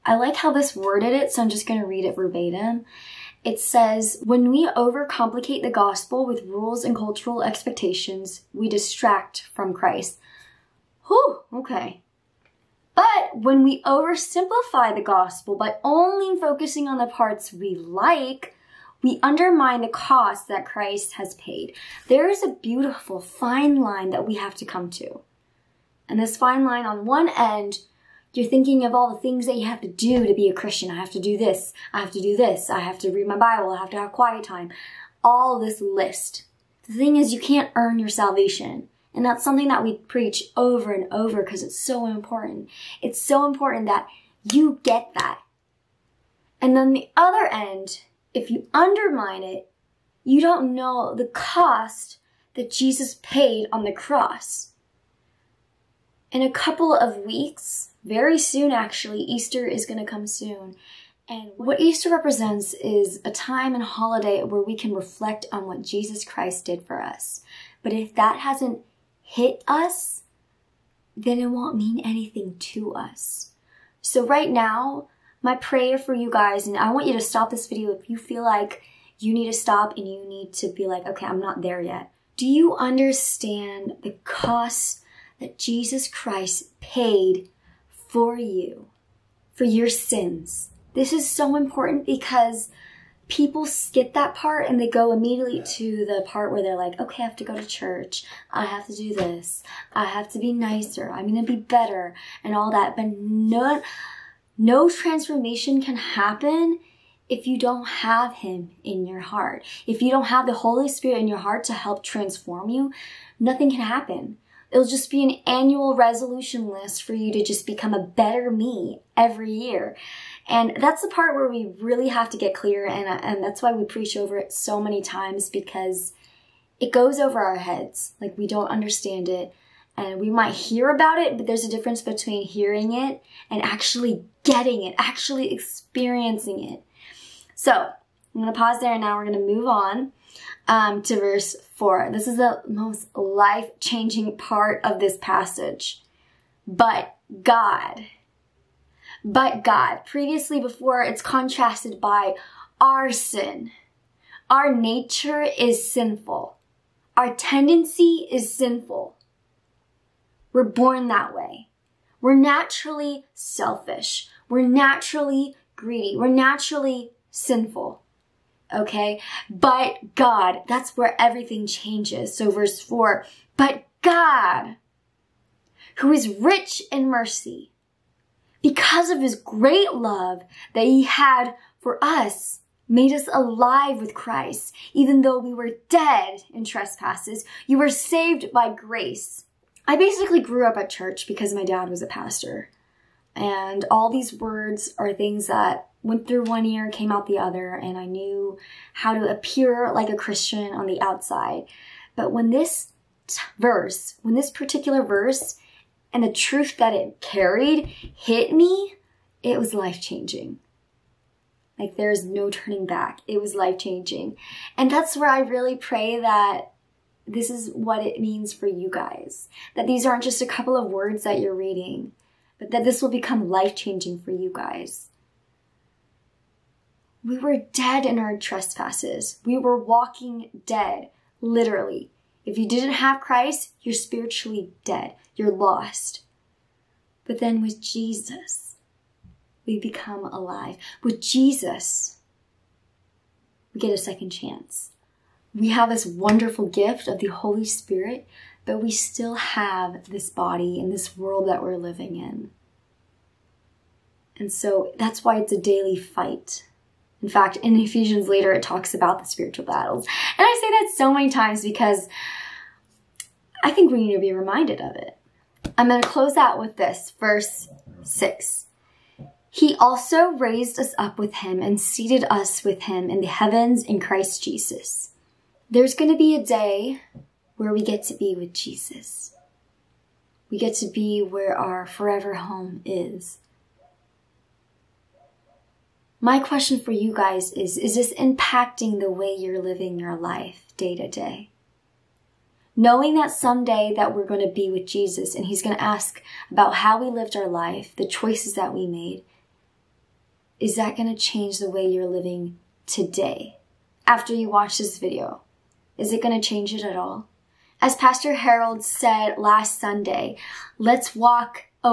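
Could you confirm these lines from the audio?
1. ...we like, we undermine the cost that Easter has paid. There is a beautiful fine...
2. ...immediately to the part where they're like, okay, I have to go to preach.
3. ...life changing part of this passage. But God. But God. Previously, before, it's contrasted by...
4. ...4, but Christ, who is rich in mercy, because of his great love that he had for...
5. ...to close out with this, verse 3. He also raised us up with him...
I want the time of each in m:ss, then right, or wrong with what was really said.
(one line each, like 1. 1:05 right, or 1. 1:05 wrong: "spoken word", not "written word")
1. 0:17 wrong: "Christ", not "Easter"
2. 1:35 wrong: "church", not "preach"
3. 2:23 right
4. 2:52 wrong: "God", not "Christ"
5. 4:26 wrong: "6", not "3".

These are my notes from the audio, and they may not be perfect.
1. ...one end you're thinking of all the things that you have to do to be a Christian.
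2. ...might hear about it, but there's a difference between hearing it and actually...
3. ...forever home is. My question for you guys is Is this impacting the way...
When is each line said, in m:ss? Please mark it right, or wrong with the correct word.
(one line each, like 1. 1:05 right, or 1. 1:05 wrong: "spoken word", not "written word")
1. 0:27 right
2. 2:10 right
3. 4:41 right.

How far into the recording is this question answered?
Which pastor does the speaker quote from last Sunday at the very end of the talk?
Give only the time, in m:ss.
5:07.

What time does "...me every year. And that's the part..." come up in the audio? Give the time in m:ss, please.
1:58.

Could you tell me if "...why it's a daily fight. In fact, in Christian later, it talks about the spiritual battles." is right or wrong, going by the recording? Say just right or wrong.
wrong.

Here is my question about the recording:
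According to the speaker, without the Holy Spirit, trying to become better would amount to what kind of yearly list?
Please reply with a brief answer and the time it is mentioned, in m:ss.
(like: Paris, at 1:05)
annual resolution list, at 1:55.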